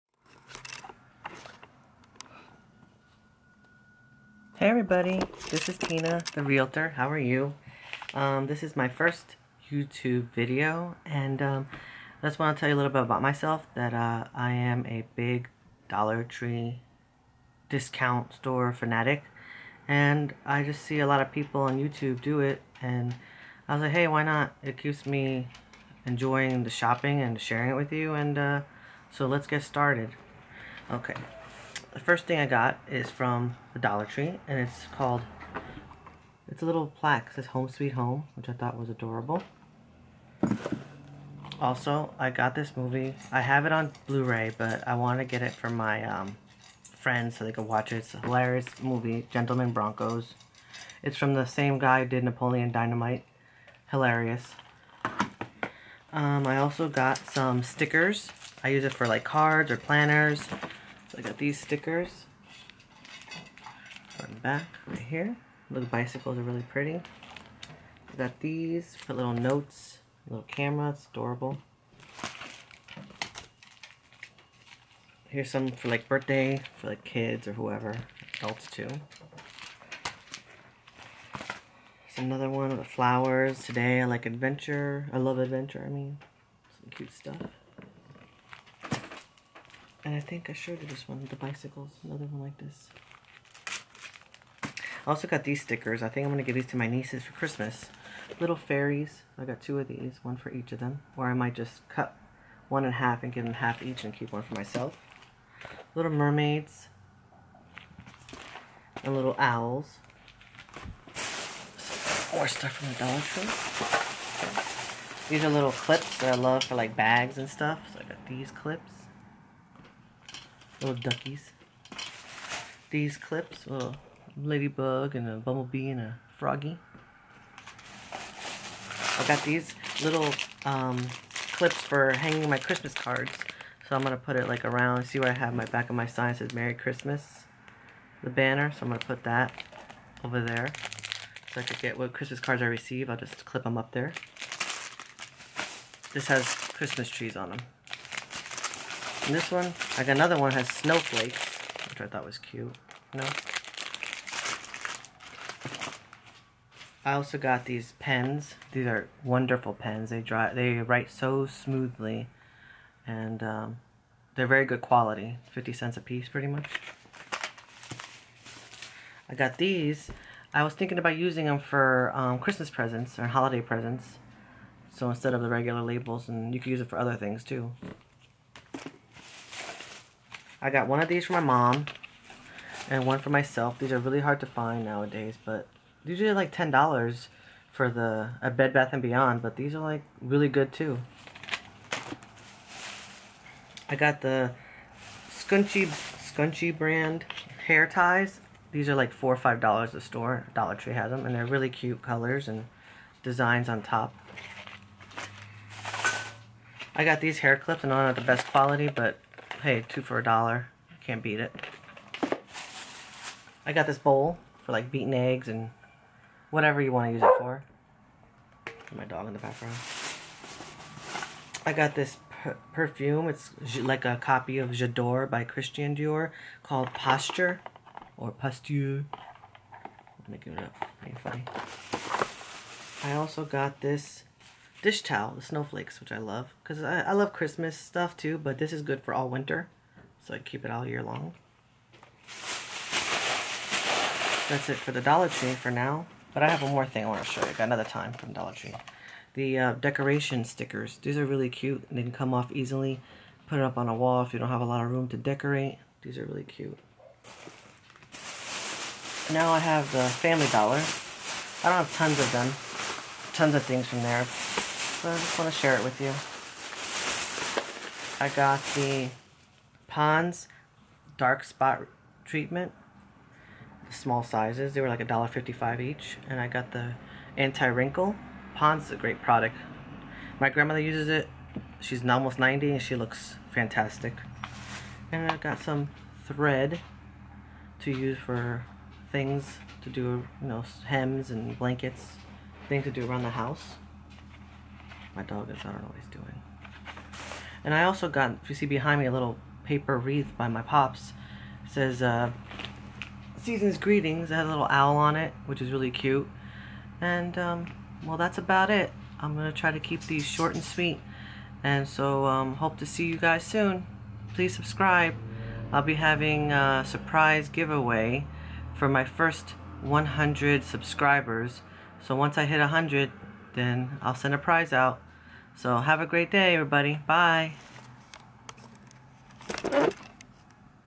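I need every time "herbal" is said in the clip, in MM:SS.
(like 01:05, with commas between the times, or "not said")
not said.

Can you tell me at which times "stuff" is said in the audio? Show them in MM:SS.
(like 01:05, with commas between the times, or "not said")
01:27, 01:52, 01:57, 03:57.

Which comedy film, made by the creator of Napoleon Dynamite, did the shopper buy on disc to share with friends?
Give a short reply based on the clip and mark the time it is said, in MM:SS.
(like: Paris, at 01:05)
Gentlemen Broncos, at 00:49.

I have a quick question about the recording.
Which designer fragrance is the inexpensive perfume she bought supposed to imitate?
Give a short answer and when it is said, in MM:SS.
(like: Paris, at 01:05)
J'adore, at 03:44.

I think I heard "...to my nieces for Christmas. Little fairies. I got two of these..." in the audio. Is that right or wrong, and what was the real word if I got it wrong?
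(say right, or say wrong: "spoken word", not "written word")
right.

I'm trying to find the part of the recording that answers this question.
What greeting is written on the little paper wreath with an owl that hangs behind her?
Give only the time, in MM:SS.
05:03.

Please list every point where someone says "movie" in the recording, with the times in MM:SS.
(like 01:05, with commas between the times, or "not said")
00:42, 00:48.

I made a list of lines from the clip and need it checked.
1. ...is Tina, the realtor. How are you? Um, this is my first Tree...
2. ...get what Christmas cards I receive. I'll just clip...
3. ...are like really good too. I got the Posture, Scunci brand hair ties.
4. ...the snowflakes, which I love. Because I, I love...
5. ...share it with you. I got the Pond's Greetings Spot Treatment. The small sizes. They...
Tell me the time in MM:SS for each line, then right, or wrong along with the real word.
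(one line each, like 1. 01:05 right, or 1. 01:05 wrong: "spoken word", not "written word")
1. 00:05 wrong: "YouTube", not "Tree"
2. 02:21 right
3. 03:09 wrong: "Scunci", not "Posture"
4. 03:55 right
5. 04:25 wrong: "Dark", not "Greetings".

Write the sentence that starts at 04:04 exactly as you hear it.
That's it for the Dollar Tree for now.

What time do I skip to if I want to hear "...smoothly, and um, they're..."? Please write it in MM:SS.
02:41.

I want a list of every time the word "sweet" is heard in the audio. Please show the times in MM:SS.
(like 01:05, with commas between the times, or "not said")
00:37, 05:10.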